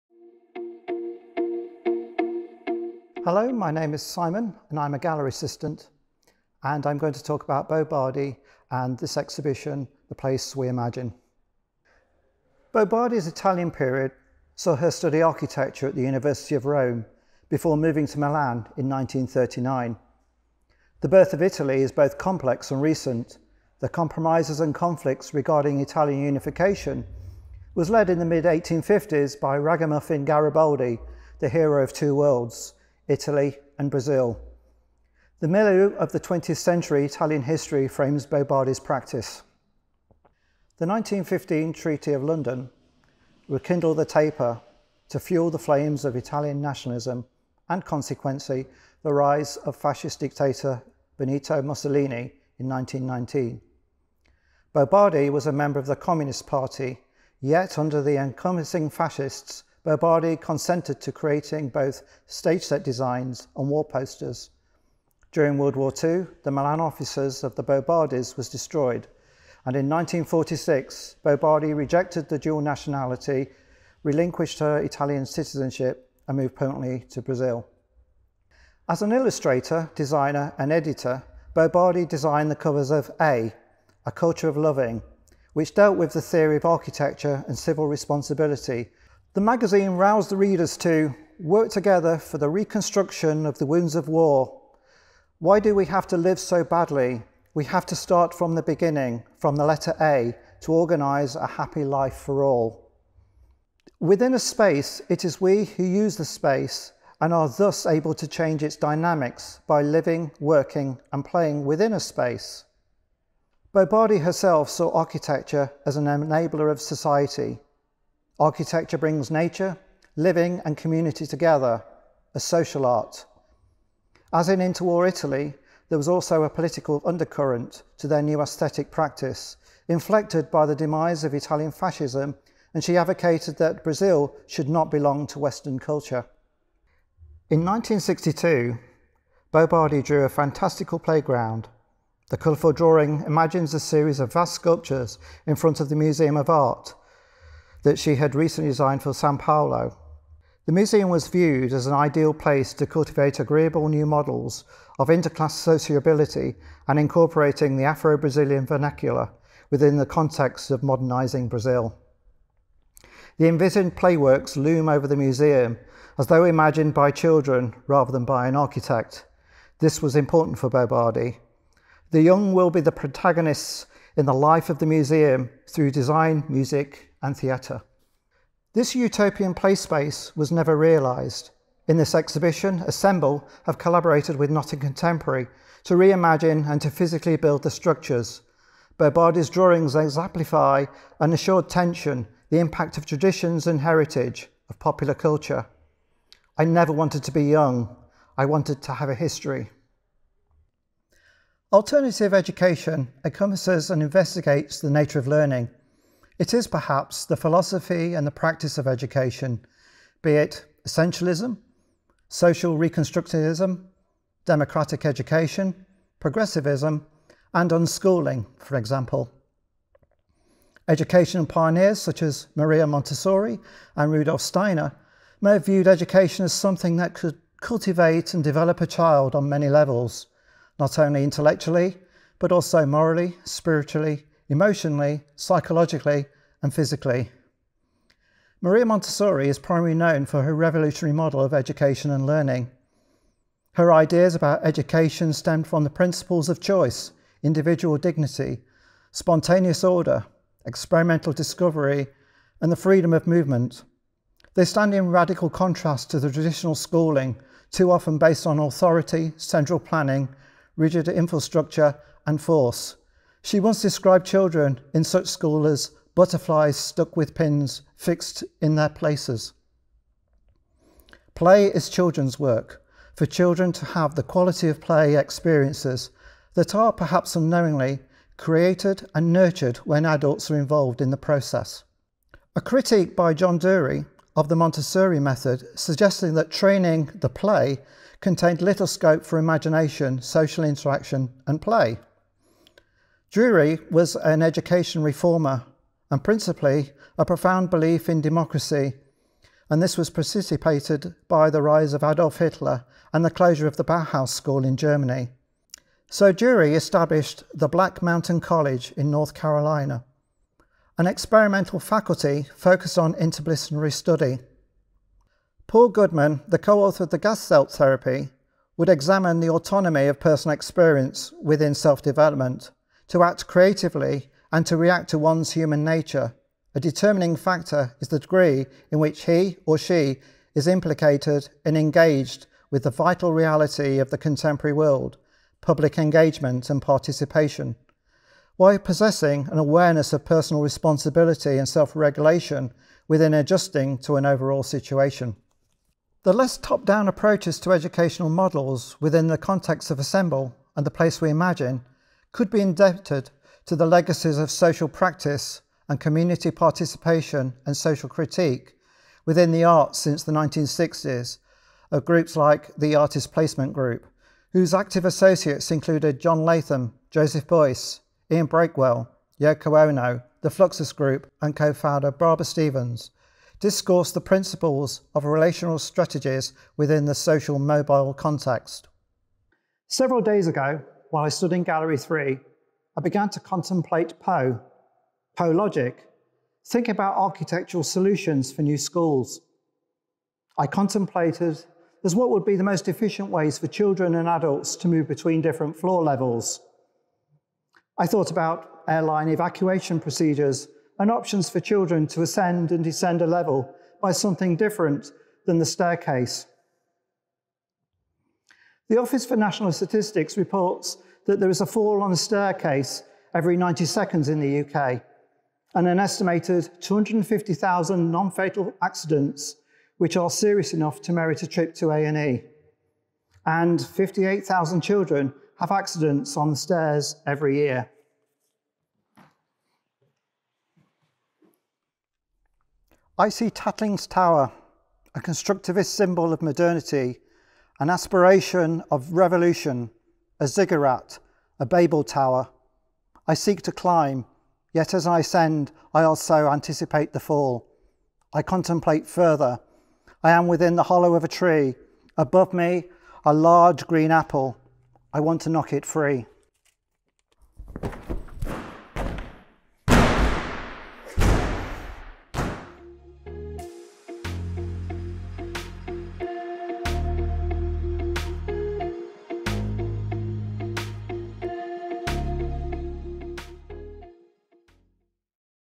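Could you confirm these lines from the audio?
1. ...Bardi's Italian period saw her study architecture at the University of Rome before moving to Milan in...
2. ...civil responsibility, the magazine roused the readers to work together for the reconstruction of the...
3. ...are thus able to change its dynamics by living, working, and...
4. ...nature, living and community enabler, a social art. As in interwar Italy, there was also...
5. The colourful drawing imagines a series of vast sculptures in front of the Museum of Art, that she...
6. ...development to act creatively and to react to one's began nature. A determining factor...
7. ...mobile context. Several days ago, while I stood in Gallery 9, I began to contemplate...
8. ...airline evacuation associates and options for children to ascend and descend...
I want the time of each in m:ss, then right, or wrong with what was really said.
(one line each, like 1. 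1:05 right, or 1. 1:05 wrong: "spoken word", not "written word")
1. 0:12 right
2. 1:27 right
3. 1:47 right
4. 1:59 wrong: "together", not "enabler"
5. 2:22 right
6. 5:22 wrong: "human", not "began"
7. 6:17 wrong: "3", not "9"
8. 6:38 wrong: "procedures", not "associates".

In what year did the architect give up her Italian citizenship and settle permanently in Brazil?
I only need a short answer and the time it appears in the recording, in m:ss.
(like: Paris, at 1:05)
1946, at 1:09.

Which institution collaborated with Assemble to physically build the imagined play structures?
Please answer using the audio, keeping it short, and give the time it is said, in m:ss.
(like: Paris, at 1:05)
Nottingham Contemporary, at 3:04.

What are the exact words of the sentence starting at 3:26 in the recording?
It is perhaps the philosophy and the practice of education, be it essentialism, social reconstructivism, democratic education, progressivism, and unschooling, for example.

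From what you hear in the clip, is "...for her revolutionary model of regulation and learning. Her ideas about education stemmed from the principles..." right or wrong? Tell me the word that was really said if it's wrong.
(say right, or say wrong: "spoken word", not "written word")
wrong: "education", not "regulation".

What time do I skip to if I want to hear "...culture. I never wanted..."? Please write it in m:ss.
3:15.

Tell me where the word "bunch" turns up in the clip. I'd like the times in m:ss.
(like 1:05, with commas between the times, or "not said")
not said.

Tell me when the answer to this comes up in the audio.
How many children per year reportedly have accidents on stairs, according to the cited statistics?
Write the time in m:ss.
7:03.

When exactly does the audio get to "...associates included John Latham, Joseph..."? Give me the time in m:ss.
6:05.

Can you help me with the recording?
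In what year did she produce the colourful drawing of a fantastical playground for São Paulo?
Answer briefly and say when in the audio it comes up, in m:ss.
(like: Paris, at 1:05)
1962, at 2:17.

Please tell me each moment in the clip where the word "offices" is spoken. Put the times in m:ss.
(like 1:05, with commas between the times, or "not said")
1:06, 6:48.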